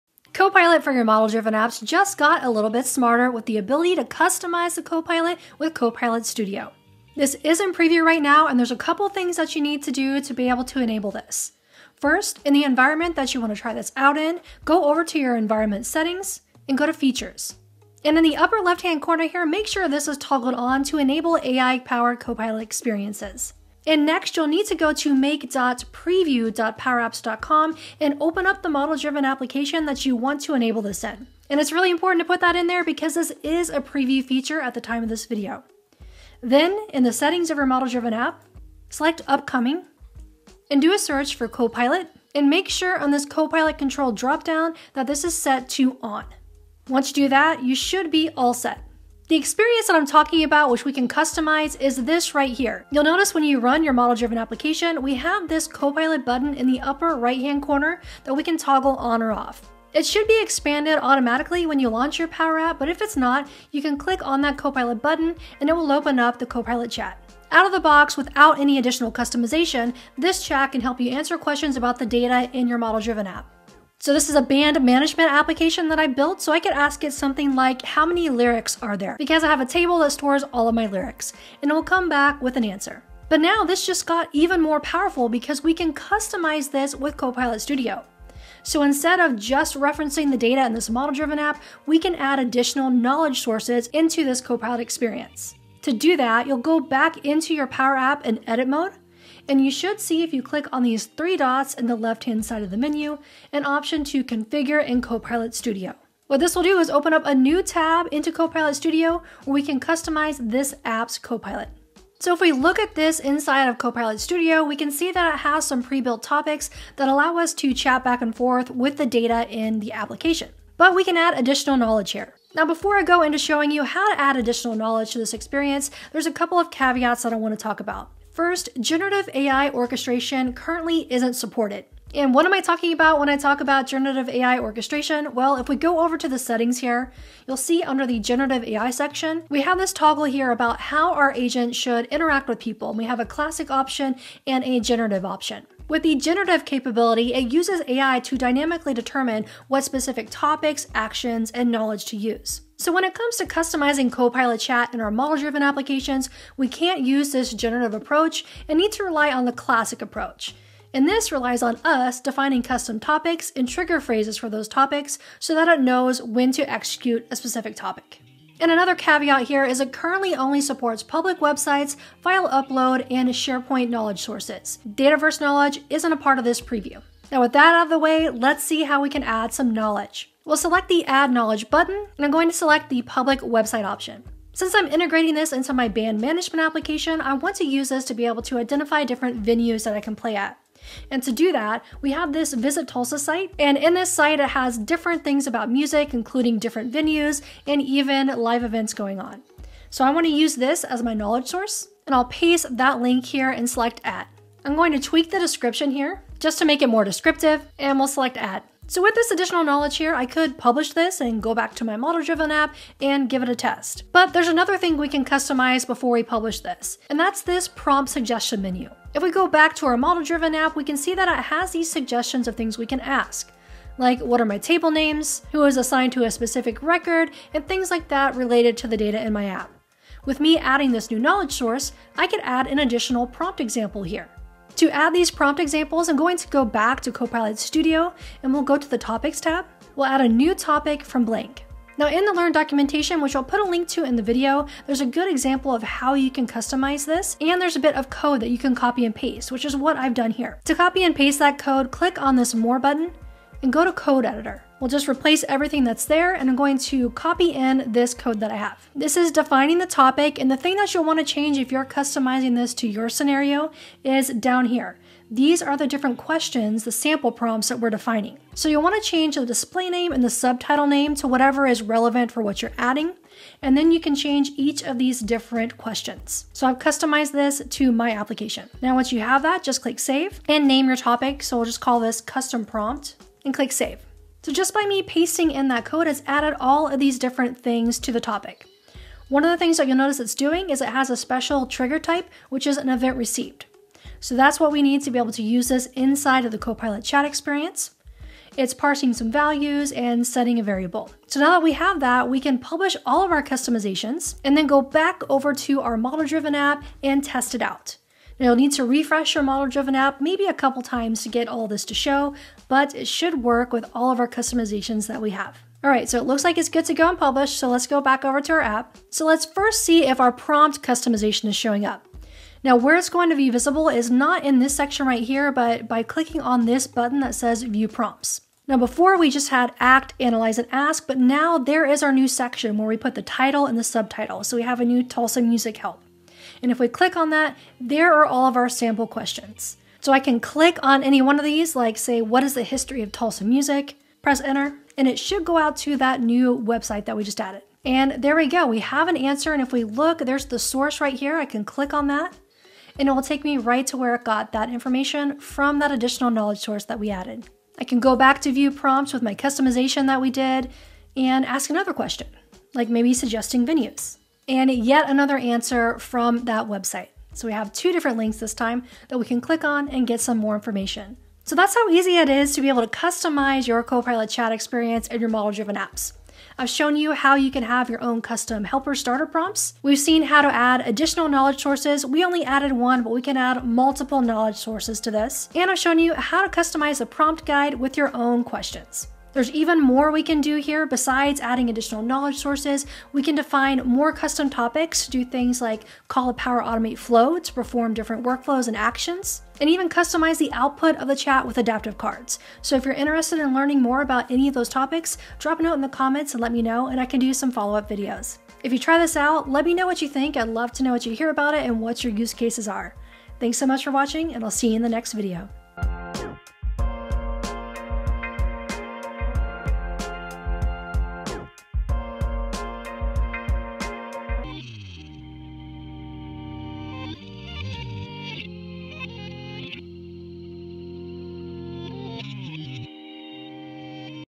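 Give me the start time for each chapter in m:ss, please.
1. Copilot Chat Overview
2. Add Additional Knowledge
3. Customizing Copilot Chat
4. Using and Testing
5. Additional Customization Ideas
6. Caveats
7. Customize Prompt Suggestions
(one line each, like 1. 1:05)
1. 0:50
2. 2:58
3. 1:37
4. 5:17
5. 6:12
6. 2:03
7. 3:30.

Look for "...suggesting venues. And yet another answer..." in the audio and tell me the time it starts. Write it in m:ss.
6:03.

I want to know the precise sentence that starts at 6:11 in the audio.
So that's how easy it is to be able to customize your Copilot chat experience in your model-driven apps.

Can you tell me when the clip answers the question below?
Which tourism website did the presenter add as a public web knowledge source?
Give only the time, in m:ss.
3:12.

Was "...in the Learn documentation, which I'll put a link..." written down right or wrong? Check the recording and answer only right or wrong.
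right.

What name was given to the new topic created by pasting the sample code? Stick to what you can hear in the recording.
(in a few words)
custom prompt.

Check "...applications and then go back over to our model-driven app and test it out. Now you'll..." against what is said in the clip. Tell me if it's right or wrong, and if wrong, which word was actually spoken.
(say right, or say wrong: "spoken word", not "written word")
wrong: "customizations", not "applications".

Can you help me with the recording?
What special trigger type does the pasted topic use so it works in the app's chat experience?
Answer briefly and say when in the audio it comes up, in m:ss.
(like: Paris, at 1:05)
event received, at 4:52.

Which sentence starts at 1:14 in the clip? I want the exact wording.
So this is a band management application that I built, so I could ask it something like, how many lyrics are there?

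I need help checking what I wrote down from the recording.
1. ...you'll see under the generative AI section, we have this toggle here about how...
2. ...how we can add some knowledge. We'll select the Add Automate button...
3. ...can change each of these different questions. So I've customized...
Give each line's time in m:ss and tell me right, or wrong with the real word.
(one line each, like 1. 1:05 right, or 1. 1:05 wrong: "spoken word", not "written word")
1. 2:17 right
2. 2:58 wrong: "Knowledge", not "Automate"
3. 4:34 right.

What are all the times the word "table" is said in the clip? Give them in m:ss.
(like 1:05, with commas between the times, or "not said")
1:19, 3:44.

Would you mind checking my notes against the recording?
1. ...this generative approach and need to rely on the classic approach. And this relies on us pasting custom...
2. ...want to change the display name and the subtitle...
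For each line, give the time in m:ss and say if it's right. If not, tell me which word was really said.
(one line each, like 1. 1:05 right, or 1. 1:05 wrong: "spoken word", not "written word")
1. 2:37 wrong: "defining", not "pasting"
2. 4:28 right.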